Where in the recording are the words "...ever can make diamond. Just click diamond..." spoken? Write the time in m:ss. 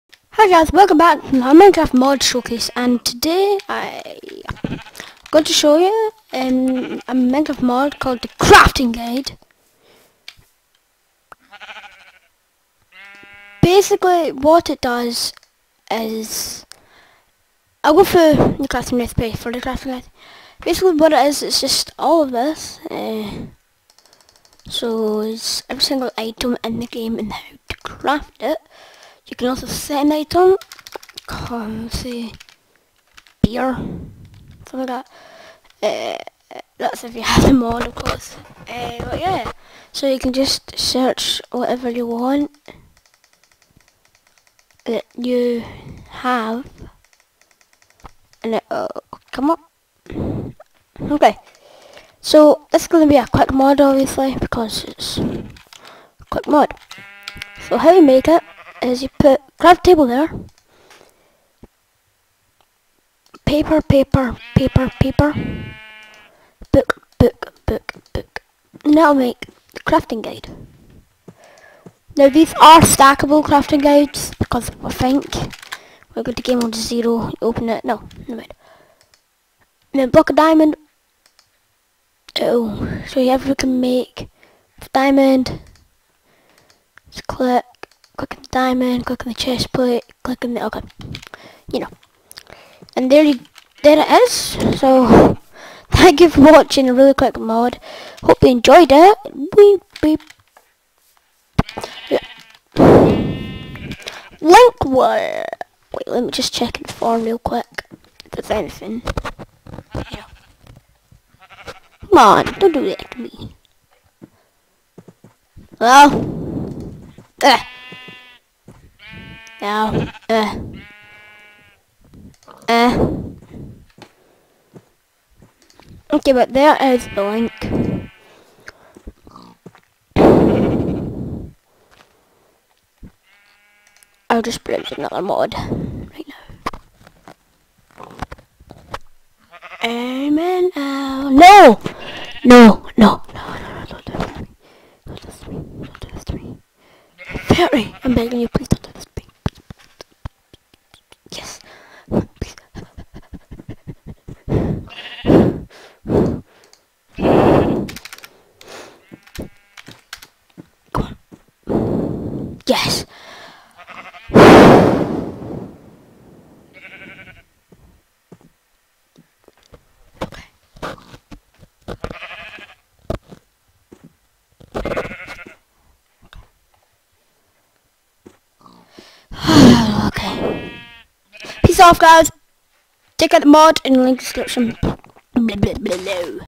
1:23.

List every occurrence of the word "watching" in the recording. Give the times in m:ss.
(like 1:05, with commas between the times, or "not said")
1:36.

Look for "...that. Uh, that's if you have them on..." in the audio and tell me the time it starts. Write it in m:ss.
0:35.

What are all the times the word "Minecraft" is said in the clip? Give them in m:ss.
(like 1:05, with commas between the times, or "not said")
0:01, 0:07.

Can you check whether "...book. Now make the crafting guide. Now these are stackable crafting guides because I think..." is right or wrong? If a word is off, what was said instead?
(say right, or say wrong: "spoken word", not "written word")
right.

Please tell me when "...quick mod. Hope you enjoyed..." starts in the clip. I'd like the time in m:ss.
1:37.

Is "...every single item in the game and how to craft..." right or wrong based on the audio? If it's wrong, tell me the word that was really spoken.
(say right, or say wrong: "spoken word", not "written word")
right.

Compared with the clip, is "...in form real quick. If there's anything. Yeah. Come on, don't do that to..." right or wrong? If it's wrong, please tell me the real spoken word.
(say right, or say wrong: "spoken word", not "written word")
right.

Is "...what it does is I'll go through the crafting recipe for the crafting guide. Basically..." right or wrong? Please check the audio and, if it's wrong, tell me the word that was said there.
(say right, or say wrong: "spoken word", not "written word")
right.